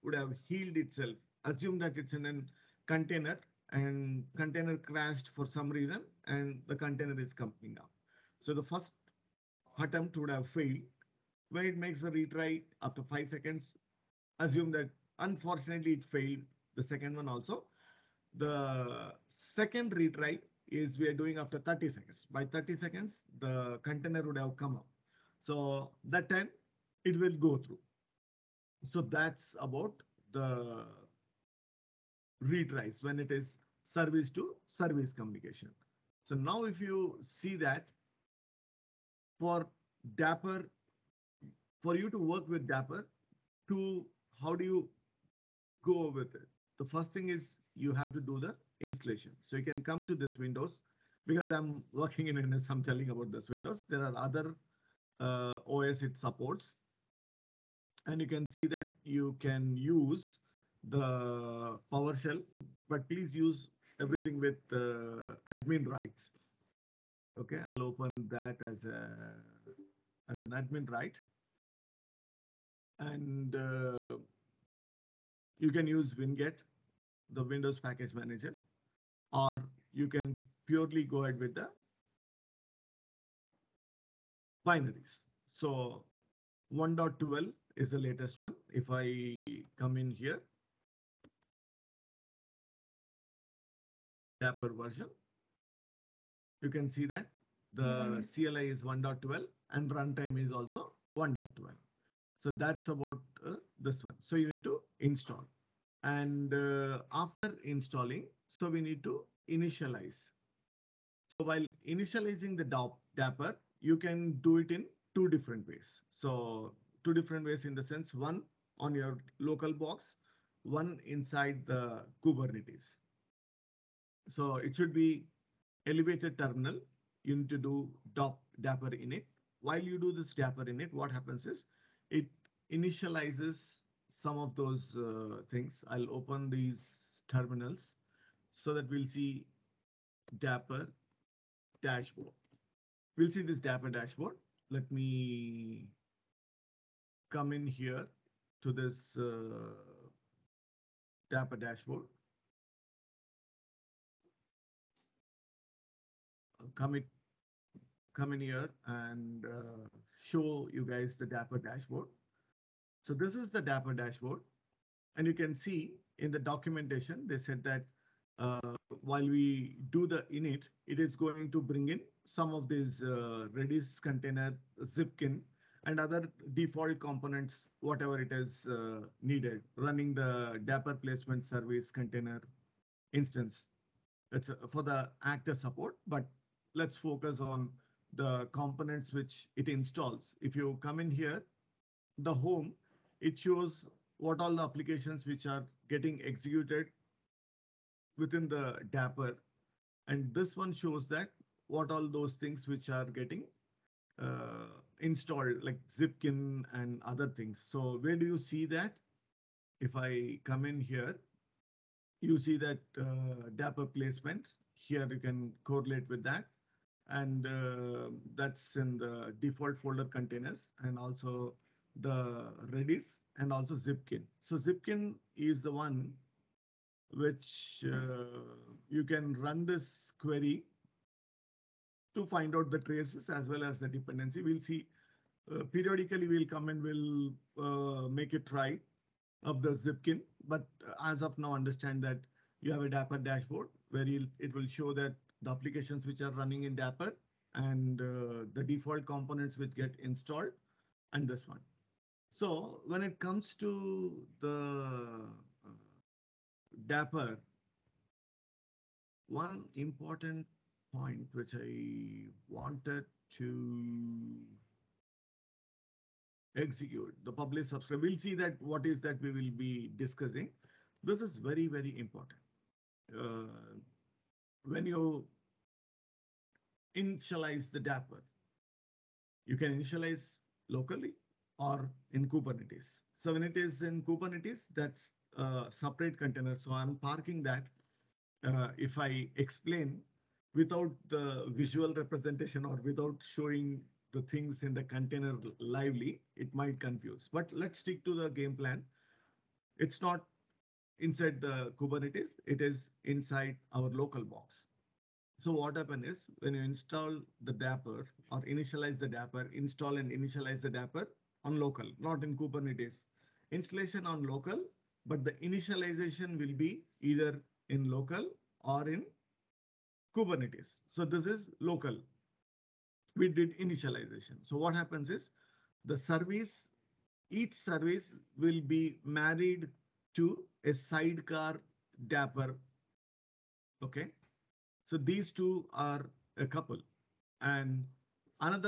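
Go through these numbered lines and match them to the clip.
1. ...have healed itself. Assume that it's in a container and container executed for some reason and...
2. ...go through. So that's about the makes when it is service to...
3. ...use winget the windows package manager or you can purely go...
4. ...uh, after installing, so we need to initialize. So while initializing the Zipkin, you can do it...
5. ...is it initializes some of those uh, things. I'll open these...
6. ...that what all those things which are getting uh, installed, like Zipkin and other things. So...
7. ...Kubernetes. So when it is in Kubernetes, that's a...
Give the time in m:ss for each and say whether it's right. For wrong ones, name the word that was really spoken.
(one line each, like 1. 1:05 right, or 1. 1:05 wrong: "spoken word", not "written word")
1. 0:00 wrong: "crashed", not "executed"
2. 0:27 wrong: "retries", not "makes"
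3. 1:15 right
4. 1:46 wrong: "Dapr", not "Zipkin"
5. 2:11 right
6. 3:21 right
7. 4:42 right.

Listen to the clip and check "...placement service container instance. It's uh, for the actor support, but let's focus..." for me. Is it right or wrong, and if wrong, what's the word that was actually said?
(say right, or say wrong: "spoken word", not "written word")
right.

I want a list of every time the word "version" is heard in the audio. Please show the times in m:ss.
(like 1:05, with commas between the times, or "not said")
1:34.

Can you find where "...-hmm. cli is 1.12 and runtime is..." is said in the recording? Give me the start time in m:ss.
1:38.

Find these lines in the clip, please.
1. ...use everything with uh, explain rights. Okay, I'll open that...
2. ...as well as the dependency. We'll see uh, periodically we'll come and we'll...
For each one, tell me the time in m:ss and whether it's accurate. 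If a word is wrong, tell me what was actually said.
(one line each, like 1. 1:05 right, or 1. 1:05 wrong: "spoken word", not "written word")
1. 1:03 wrong: "admin", not "explain"
2. 3:53 right.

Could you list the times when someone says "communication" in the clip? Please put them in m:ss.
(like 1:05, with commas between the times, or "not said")
0:35.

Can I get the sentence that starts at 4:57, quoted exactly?
But let's stick to the game plan.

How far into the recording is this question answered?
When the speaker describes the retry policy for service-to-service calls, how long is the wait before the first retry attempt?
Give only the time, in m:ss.
0:13.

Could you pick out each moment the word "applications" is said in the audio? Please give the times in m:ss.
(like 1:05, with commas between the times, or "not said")
3:14, 4:05.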